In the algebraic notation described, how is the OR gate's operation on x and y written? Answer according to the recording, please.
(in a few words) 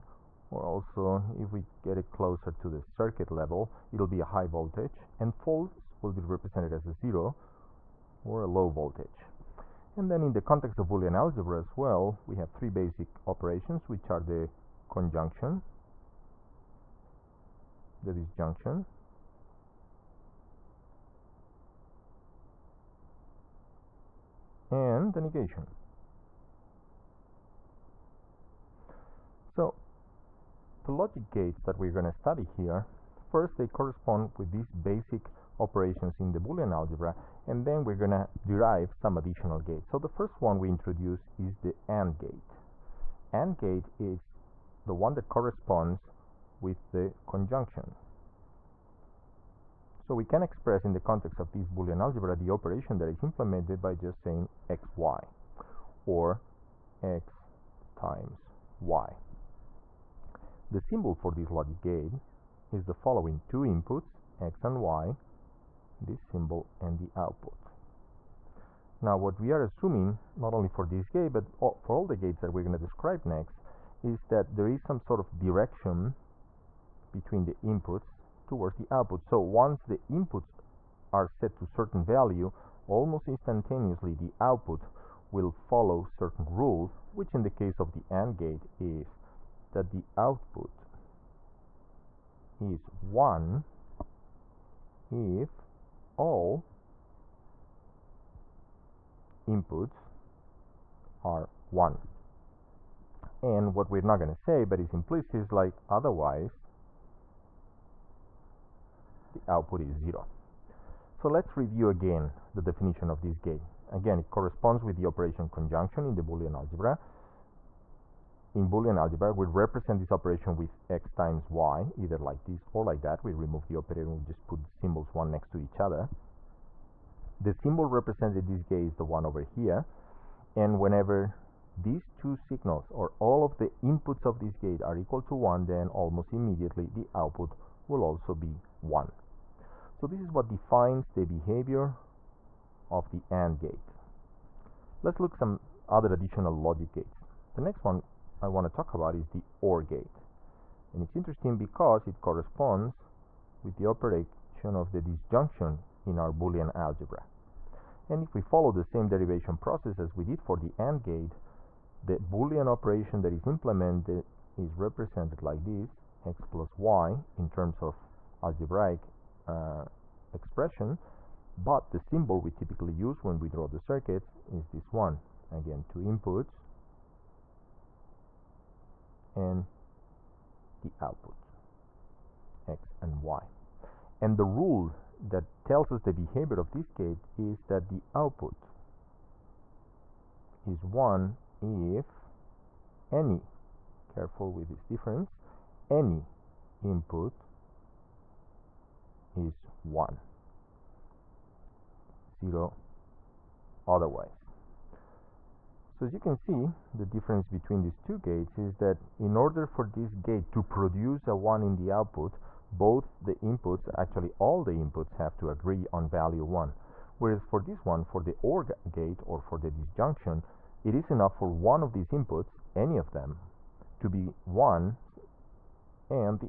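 x plus y.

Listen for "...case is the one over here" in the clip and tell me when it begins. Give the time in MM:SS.
02:08.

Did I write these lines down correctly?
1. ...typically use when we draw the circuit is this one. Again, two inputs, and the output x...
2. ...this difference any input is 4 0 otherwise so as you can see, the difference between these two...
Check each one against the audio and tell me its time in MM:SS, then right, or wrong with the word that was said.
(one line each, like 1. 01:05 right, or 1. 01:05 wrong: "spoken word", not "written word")
1. 02:52 right
2. 03:14 wrong: "1", not "4".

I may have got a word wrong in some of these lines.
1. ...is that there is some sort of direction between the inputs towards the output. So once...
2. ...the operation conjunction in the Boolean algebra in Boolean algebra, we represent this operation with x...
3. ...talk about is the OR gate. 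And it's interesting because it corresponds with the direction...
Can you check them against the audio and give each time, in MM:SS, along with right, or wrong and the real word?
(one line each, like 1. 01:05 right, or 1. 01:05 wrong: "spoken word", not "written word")
1. 01:14 right
2. 01:54 right
3. 02:28 wrong: "operation", not "direction".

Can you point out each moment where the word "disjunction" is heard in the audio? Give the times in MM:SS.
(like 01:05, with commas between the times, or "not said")
00:18, 02:35, 03:39.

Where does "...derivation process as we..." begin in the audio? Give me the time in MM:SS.
02:39.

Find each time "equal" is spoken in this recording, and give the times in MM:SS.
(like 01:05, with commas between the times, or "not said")
02:14.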